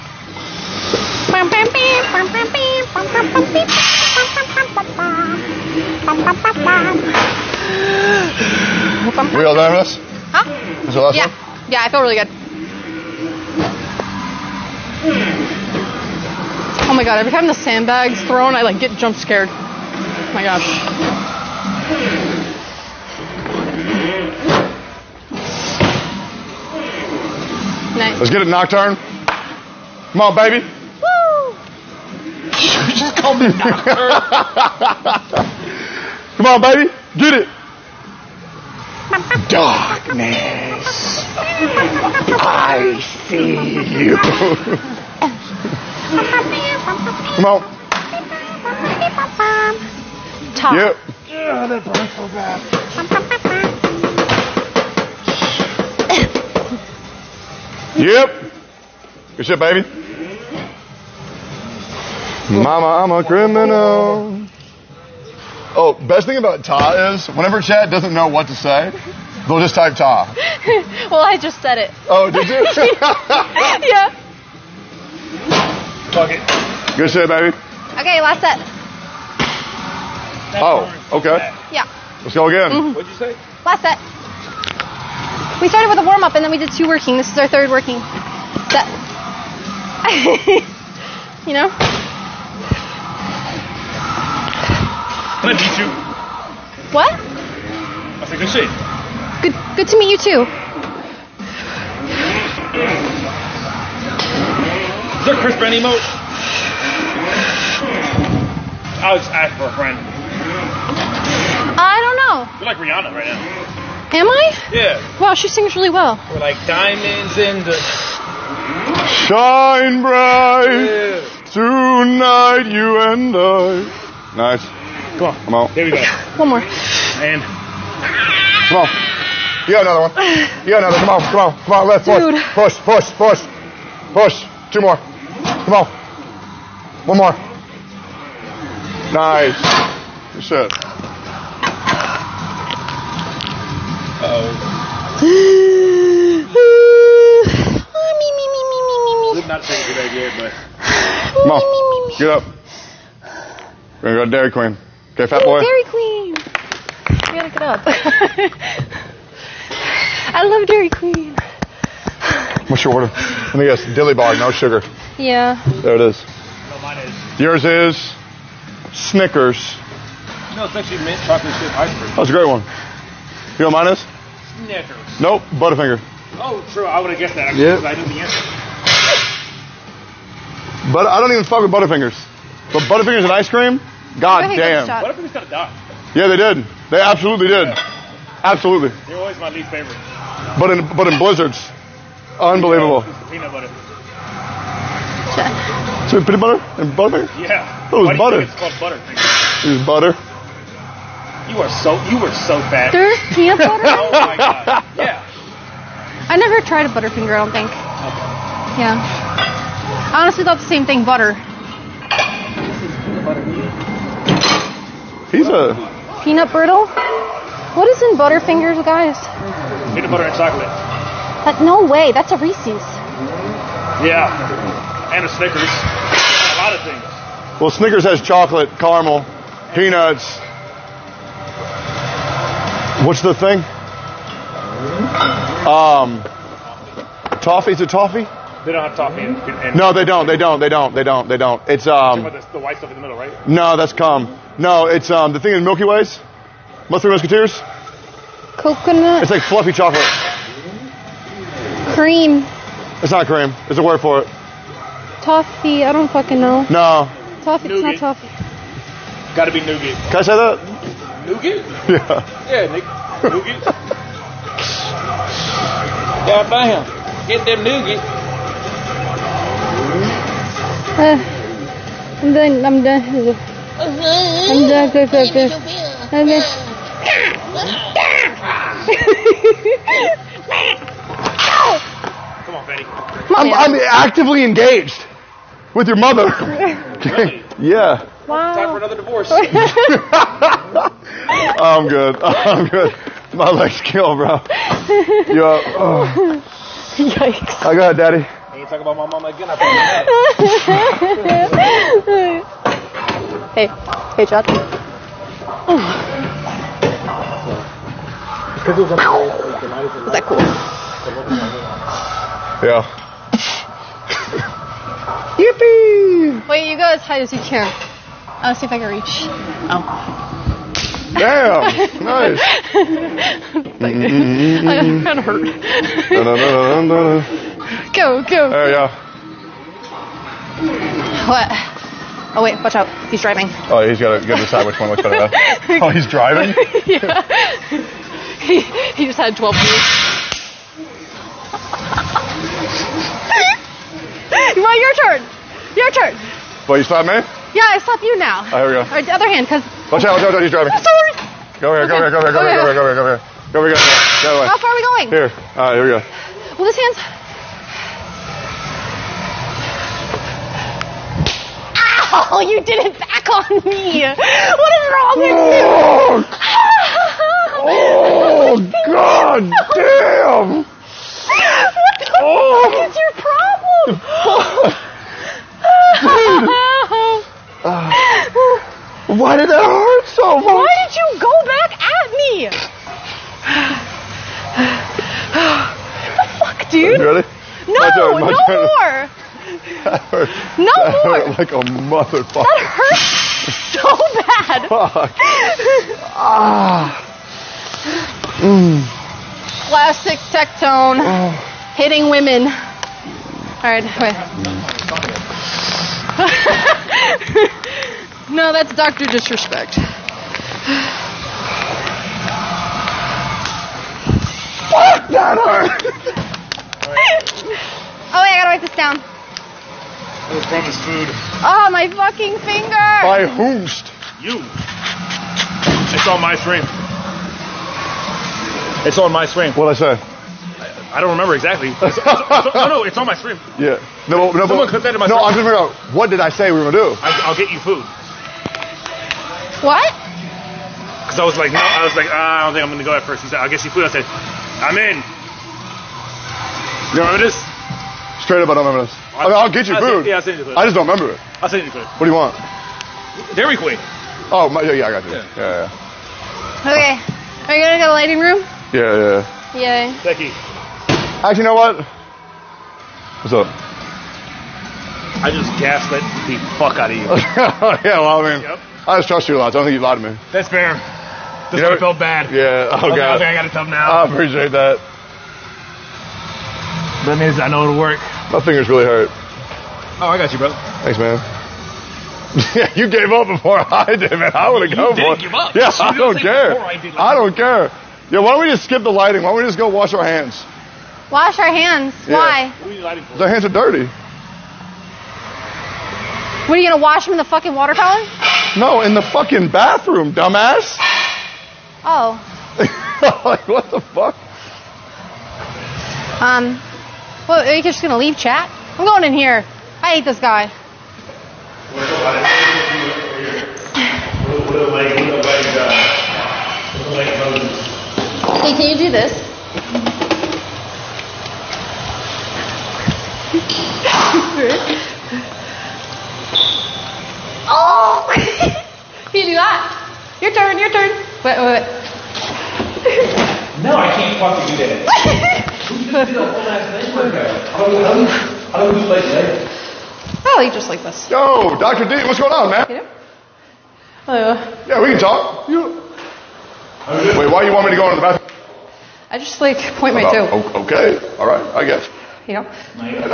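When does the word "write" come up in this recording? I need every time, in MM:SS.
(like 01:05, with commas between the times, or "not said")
06:58.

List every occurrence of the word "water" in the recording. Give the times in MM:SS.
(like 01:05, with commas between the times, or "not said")
08:17.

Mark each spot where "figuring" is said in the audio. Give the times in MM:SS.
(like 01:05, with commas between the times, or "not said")
07:15.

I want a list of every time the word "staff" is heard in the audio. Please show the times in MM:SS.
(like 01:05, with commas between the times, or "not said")
not said.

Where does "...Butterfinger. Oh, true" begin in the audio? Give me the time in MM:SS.
02:55.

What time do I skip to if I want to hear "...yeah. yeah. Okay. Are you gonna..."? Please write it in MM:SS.
07:35.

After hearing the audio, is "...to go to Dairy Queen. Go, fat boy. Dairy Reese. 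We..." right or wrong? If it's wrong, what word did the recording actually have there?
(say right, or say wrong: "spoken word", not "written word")
wrong: "Queen", not "Reese".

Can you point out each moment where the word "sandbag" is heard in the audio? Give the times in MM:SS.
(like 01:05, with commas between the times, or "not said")
00:17.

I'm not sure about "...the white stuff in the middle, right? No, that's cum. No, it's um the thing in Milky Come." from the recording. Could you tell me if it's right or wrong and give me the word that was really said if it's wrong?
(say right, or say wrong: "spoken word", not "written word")
wrong: "Ways", not "Come".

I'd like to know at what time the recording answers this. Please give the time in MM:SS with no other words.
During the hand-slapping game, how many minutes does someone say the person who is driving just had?
05:39.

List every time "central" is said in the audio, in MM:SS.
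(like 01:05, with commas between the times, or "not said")
not said.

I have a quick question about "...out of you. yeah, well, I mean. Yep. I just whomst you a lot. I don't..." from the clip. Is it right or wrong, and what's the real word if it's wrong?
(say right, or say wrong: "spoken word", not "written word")
wrong: "trust", not "whomst".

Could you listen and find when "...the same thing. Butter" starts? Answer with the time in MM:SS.
03:30.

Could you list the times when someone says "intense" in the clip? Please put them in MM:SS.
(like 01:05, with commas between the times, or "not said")
not said.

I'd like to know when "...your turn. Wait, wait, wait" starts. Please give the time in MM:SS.
08:50.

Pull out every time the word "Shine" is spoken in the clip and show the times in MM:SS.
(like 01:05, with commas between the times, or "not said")
01:59.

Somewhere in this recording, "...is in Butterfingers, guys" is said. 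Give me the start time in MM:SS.
03:37.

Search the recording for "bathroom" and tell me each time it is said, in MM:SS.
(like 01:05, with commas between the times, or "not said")
08:19, 09:08.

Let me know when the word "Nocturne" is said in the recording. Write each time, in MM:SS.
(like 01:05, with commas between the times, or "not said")
00:28.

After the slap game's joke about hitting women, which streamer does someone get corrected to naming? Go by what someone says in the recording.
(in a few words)
Dr. Disrespect.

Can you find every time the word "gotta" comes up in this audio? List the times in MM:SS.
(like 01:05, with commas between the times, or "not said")
02:37, 06:58.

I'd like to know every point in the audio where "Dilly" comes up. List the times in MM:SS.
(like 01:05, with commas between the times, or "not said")
02:43.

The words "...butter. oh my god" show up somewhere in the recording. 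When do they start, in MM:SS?
03:23.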